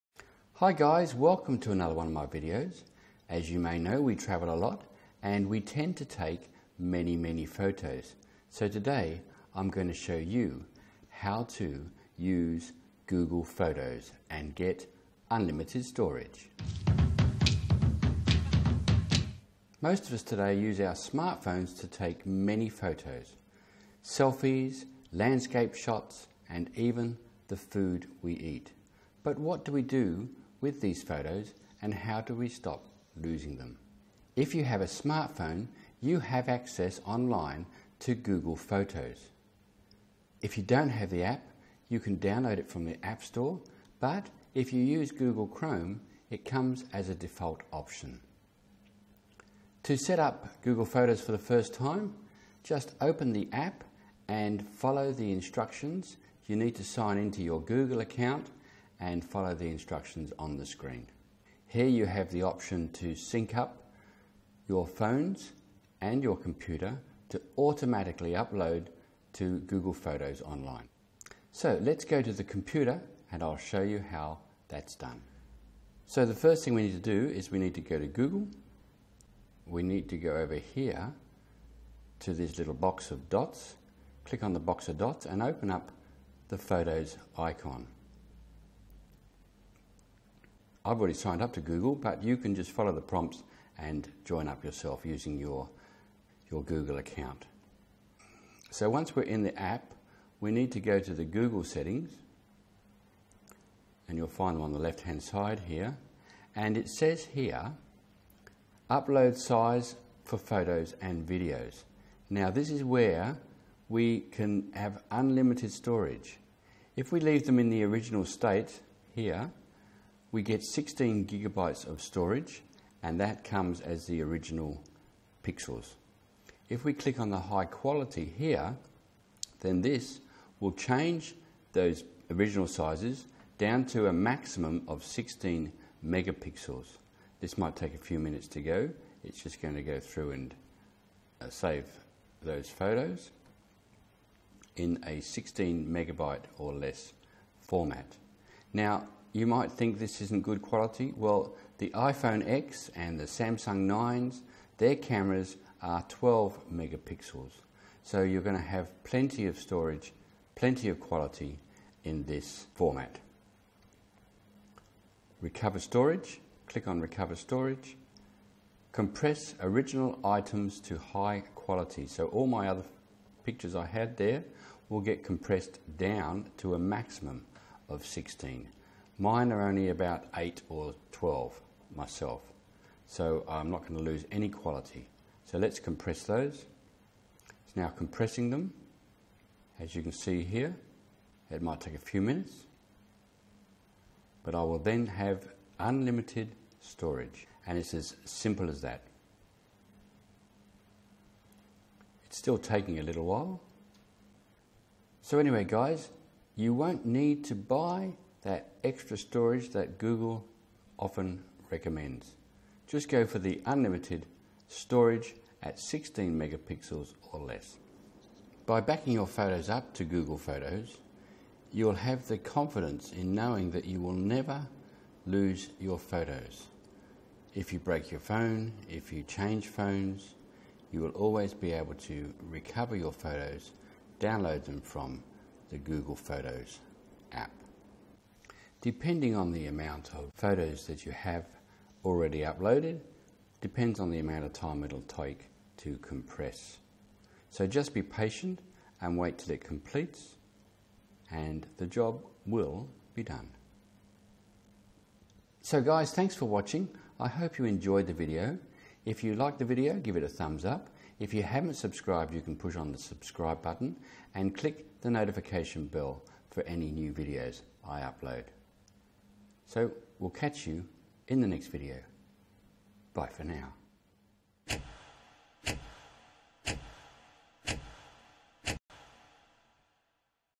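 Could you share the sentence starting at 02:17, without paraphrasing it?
This might take a few minutes to go.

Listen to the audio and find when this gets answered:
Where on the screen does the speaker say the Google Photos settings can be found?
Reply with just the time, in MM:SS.
01:44.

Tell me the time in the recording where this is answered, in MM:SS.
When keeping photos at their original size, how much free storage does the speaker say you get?
02:00.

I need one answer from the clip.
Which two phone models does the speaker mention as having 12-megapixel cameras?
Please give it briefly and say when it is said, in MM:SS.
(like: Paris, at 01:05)
iPhone X and Samsung 9s, at 02:31.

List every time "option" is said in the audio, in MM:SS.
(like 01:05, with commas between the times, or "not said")
00:47, 01:02.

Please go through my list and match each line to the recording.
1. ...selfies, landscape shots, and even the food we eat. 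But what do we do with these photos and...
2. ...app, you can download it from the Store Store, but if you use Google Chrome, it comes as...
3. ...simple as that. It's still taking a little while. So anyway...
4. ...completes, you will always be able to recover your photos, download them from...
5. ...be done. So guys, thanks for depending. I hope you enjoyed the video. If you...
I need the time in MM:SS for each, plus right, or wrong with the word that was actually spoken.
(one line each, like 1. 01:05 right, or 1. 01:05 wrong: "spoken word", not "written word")
1. 00:24 right
2. 00:41 wrong: "App", not "Store"
3. 03:18 right
4. 03:49 wrong: "phones", not "completes"
5. 04:13 wrong: "watching", not "depending".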